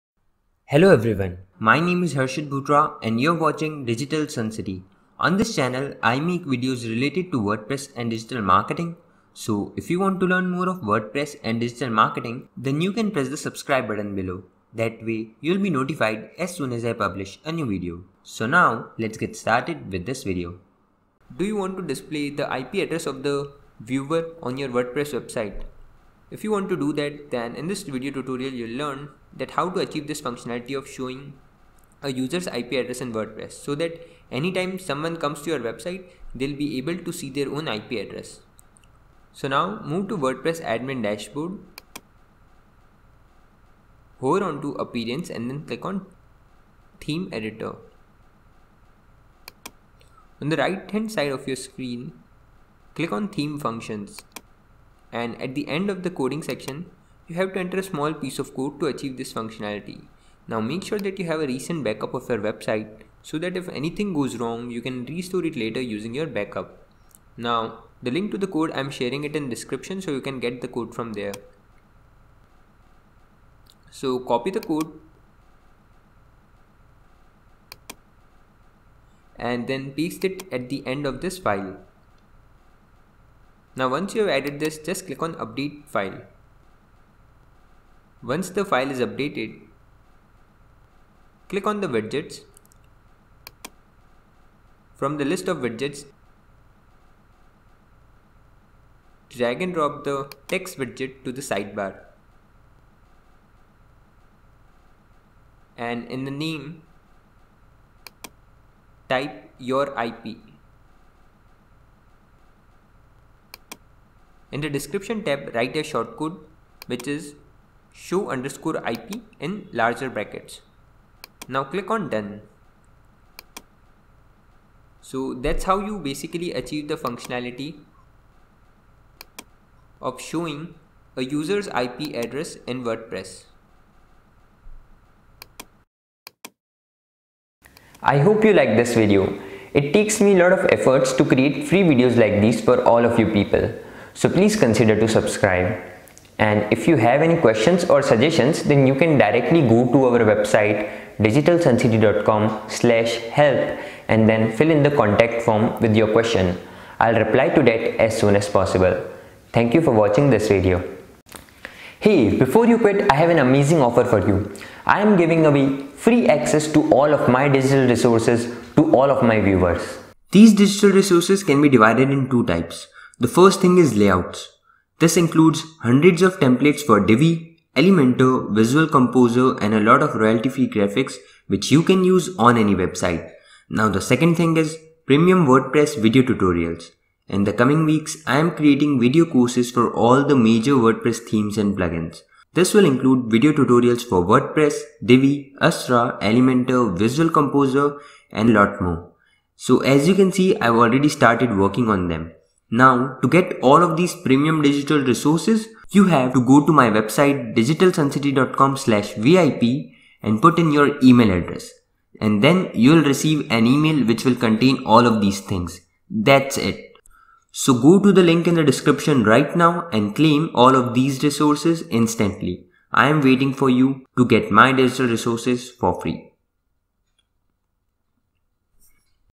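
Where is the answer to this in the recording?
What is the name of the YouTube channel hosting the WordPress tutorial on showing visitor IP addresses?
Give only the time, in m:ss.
0:03.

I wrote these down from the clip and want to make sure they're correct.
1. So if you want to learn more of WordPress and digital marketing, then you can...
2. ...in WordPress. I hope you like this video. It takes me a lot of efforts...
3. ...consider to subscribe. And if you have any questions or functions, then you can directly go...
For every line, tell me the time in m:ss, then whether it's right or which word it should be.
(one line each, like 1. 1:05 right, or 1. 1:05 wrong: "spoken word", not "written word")
1. 0:09 right
2. 2:12 right
3. 2:24 wrong: "suggestions", not "functions".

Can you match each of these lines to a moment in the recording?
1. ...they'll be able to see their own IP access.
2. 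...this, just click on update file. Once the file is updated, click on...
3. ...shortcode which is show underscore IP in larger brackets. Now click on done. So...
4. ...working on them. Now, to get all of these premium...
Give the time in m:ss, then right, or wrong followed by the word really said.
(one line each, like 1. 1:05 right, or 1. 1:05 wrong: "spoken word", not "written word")
1. 0:36 wrong: "address", not "access"
2. 1:24 right
3. 1:55 right
4. 3:21 right.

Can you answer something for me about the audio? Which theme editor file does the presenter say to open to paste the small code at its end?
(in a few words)
Theme functions.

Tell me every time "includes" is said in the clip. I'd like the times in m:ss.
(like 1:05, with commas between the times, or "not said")
2:55, 3:12.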